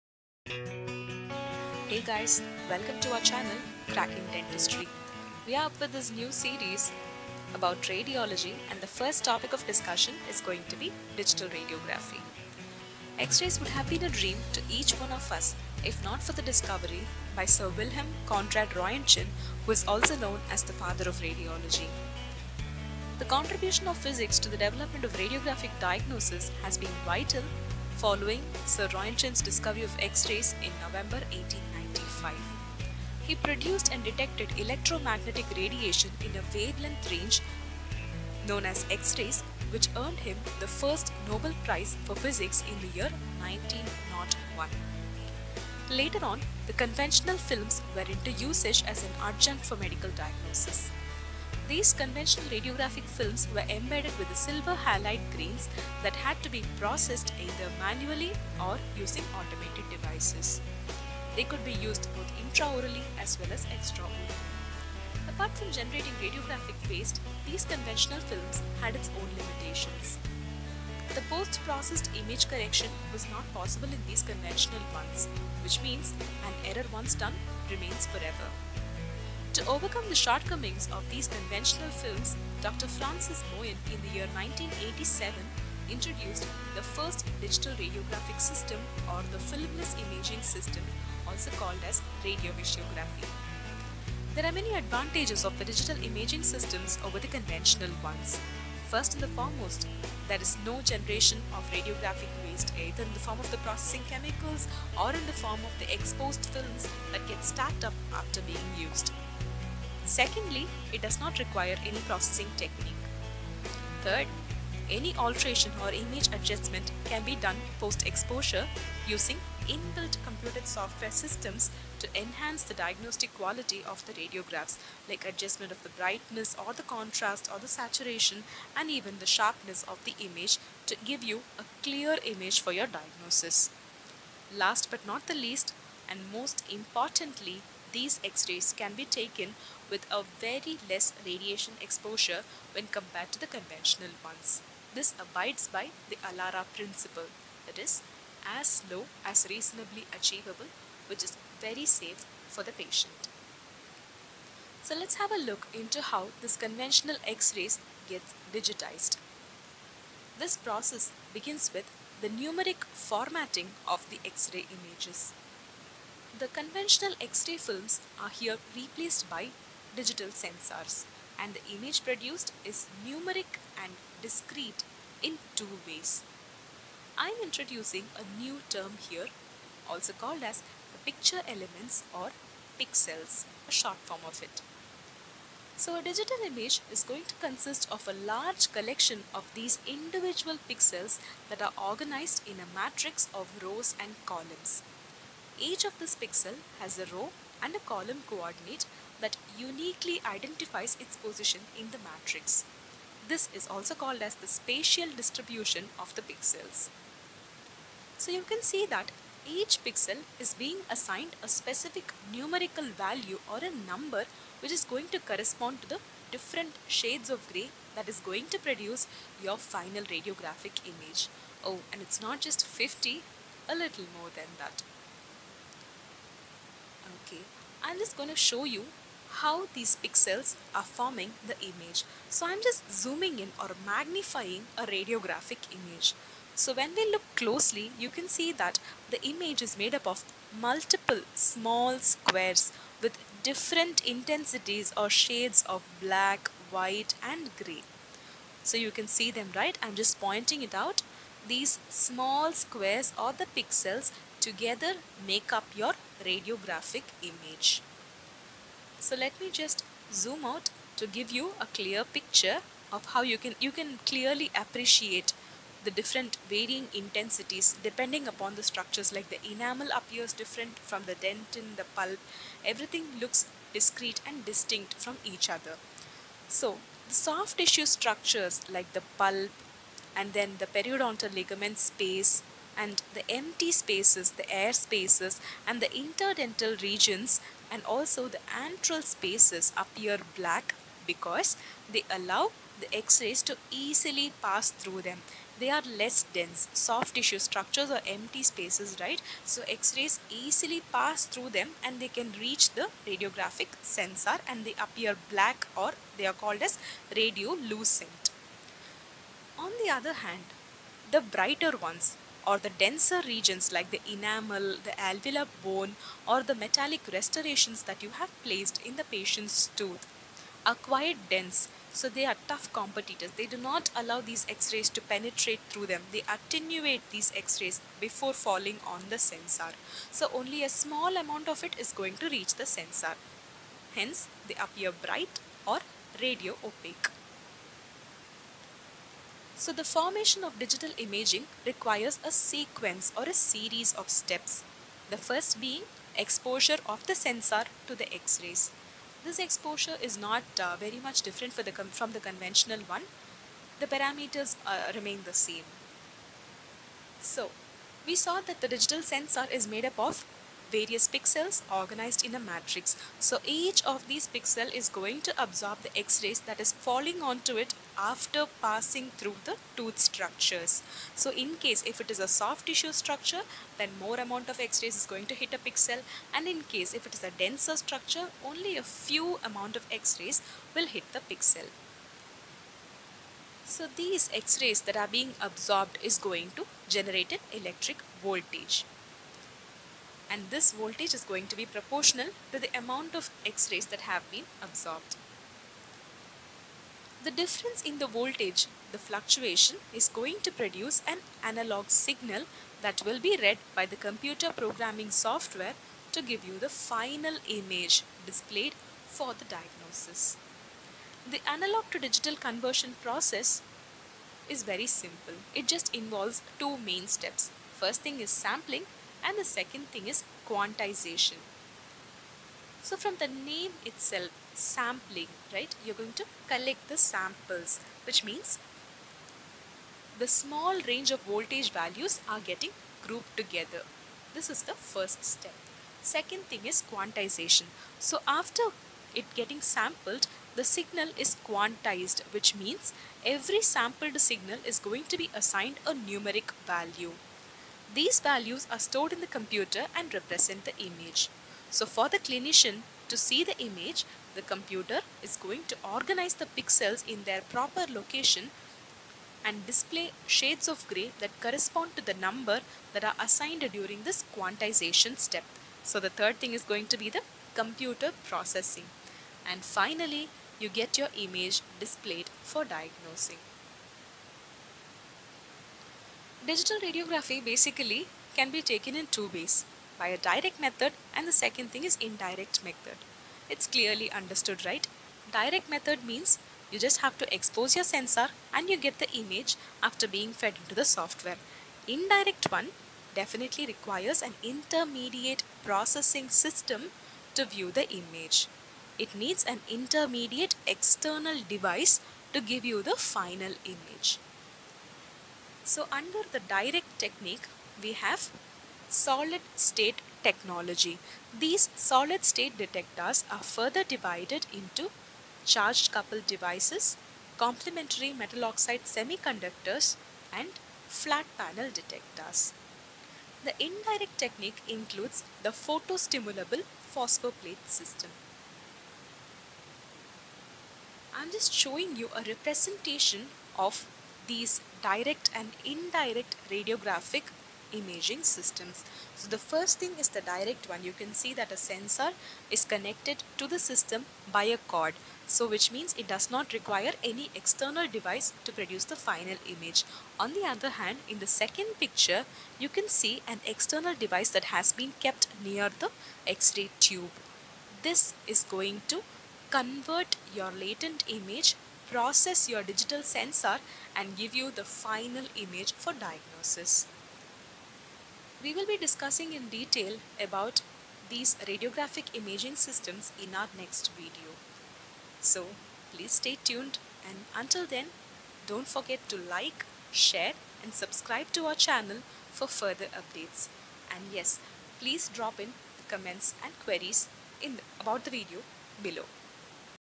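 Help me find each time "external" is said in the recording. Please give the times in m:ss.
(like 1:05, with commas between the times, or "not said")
8:20, 9:07, 9:13.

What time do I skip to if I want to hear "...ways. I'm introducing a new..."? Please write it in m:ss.
2:55.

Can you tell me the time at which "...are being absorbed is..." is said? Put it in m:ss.
6:24.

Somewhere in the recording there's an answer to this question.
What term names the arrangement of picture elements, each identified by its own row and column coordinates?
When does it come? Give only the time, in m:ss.
3:24.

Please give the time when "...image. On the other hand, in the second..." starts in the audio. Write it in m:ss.
9:09.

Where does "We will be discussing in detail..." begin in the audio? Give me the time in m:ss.
9:28.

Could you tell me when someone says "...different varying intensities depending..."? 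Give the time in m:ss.
4:25.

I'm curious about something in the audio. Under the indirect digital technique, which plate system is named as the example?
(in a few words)
Photostimulable phosphor plate.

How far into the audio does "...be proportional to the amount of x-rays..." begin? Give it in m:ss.
6:31.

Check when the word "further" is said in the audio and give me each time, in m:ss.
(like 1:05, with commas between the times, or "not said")
8:33, 9:42.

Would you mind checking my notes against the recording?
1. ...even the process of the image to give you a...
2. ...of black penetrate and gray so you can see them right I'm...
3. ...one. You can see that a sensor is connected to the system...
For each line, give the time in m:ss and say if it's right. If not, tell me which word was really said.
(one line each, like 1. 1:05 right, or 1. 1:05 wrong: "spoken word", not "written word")
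1. 2:08 wrong: "sharpness", not "process"
2. 4:05 wrong: "white", not "penetrate"
3. 9:00 right.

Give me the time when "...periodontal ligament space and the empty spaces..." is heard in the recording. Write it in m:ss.
4:40.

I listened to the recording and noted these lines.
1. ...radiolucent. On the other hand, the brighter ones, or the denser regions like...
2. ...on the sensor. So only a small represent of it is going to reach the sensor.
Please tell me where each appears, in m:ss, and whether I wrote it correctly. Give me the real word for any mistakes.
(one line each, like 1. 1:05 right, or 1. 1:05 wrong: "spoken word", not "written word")
1. 5:07 right
2. 5:28 wrong: "amount", not "represent".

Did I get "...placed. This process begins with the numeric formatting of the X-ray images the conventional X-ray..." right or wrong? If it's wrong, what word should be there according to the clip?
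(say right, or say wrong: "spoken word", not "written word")
wrong: "digitized", not "placed".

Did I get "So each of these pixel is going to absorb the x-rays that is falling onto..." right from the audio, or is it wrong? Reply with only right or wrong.
right.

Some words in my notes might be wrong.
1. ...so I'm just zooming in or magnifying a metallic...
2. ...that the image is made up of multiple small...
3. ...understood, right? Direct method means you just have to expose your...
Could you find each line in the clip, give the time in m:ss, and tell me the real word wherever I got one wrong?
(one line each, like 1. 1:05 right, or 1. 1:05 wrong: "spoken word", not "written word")
1. 3:52 wrong: "radiographic", not "metallic"
2. 3:58 right
3. 8:04 right.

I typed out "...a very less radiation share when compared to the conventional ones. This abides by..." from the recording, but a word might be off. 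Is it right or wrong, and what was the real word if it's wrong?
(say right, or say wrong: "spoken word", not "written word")
wrong: "exposure", not "share".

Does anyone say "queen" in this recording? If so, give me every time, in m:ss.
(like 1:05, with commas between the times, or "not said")
not said.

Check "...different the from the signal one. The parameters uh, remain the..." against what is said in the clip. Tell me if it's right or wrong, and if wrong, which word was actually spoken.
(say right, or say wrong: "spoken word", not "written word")
wrong: "conventional", not "signal".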